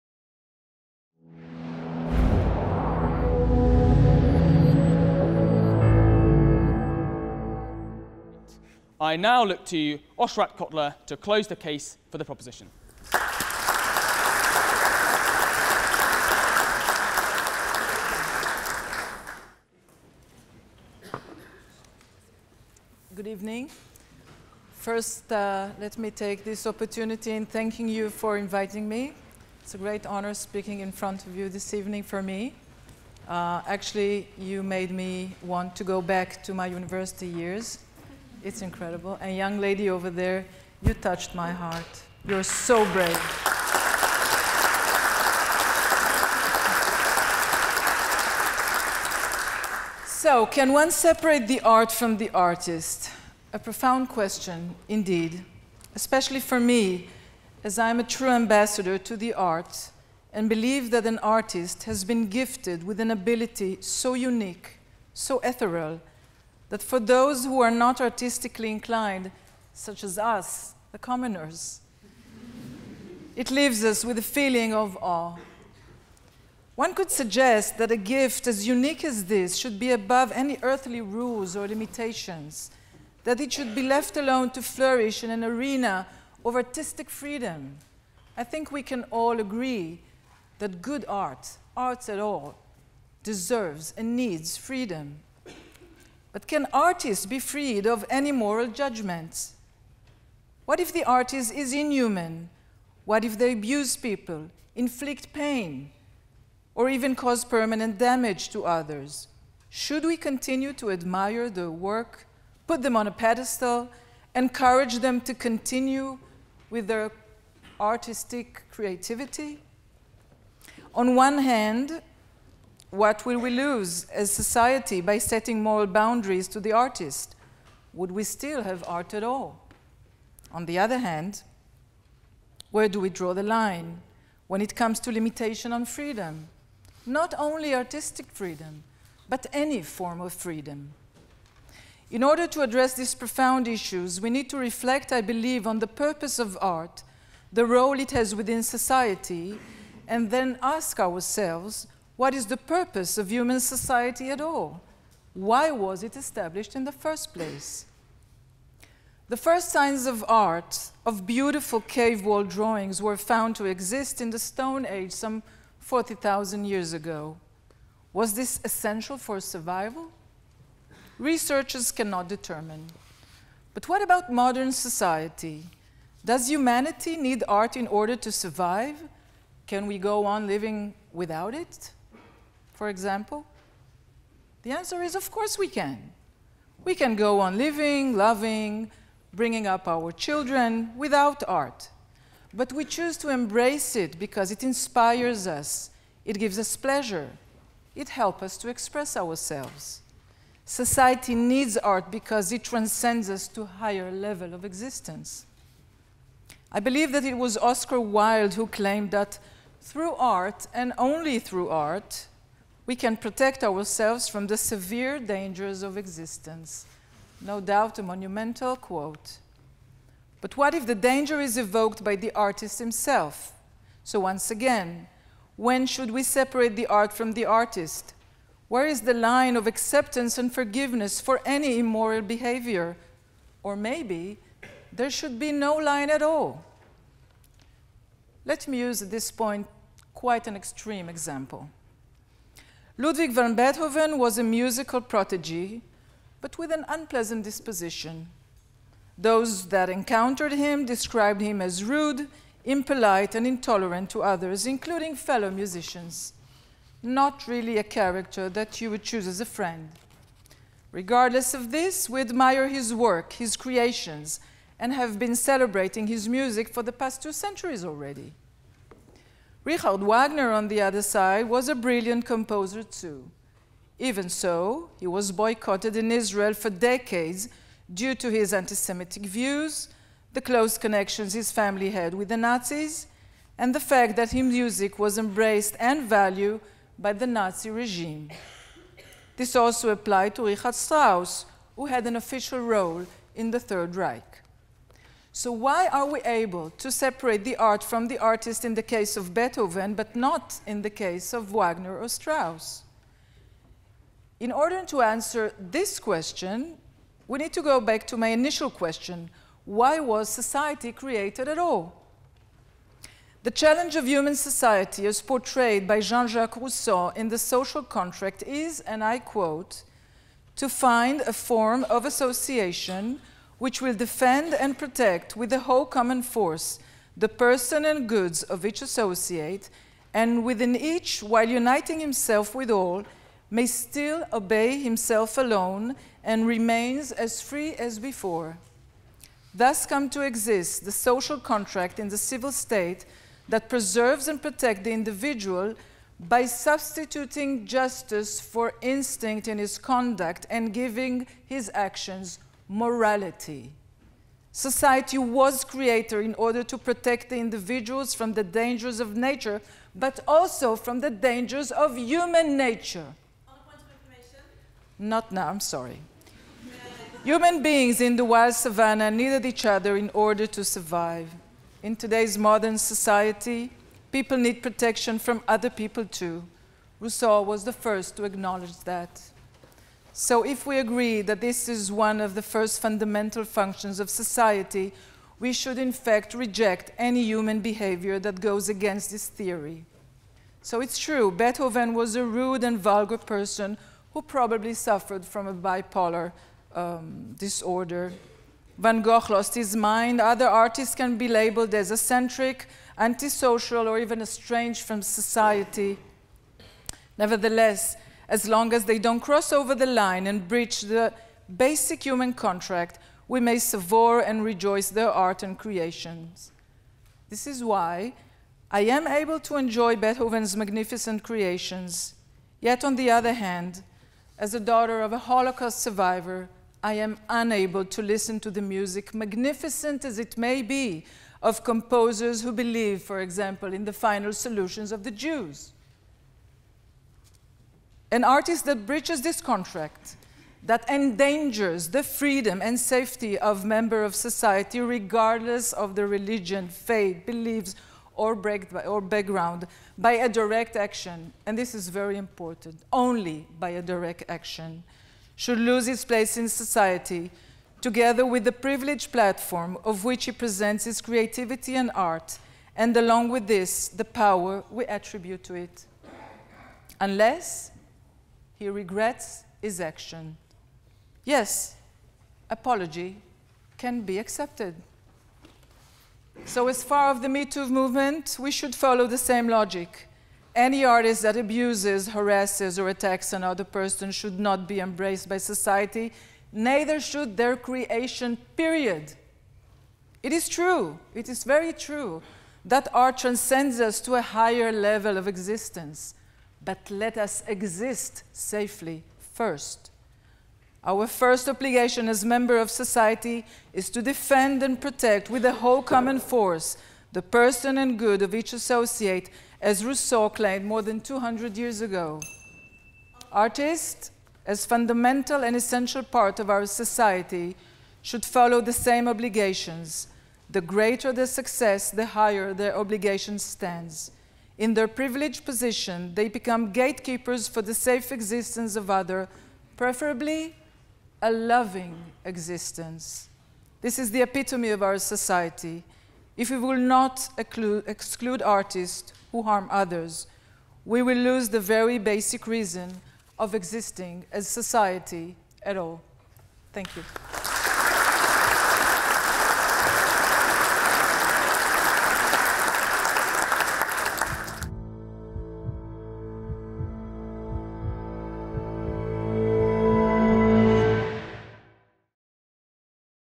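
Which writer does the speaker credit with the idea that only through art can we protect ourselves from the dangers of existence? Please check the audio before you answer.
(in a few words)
Oscar Wilde.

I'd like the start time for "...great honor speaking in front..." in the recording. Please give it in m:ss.
0:29.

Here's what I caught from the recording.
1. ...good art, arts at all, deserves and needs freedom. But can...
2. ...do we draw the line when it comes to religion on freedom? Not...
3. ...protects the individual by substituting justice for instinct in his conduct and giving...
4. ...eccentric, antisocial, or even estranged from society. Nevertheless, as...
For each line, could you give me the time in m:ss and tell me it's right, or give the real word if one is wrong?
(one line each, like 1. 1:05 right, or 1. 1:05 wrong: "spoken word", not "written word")
1. 1:30 right
2. 2:12 wrong: "limitation", not "religion"
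3. 5:44 right
4. 6:41 right.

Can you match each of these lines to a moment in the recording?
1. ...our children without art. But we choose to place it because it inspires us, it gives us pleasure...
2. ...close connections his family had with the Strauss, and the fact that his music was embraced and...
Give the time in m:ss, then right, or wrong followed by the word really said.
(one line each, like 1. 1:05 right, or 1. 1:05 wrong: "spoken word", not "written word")
1. 3:09 wrong: "embrace", not "place"
2. 4:40 wrong: "Nazis", not "Strauss".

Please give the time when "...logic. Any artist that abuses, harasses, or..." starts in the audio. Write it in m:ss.
7:59.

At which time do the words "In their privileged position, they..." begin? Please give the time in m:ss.
8:44.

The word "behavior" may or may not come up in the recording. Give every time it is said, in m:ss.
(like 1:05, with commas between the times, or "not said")
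3:52, 6:27.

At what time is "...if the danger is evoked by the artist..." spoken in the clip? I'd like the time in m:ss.
3:40.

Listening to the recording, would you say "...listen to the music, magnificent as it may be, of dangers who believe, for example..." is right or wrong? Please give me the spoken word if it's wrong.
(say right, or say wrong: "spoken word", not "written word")
wrong: "composers", not "dangers".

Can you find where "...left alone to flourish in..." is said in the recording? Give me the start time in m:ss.
1:23.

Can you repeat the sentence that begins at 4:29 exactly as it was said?
Richard Wagner, on the other side, was a brilliant composer too.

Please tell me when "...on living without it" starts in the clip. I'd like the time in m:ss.
3:00.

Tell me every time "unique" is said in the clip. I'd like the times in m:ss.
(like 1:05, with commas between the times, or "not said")
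1:04, 1:18.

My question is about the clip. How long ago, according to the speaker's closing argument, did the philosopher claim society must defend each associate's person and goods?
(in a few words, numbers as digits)
more than 200 years.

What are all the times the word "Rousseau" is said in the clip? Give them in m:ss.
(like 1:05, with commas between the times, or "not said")
5:16, 6:16, 8:29.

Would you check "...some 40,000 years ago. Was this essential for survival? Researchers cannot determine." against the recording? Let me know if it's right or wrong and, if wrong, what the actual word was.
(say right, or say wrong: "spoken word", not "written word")
right.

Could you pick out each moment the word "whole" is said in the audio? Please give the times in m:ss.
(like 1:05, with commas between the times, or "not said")
5:25, 8:25.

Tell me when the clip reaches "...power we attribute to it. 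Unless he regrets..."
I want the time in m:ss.
7:44.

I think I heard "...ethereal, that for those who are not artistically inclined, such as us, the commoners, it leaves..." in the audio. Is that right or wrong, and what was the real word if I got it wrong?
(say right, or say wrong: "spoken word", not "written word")
right.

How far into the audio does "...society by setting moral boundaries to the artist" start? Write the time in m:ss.
2:04.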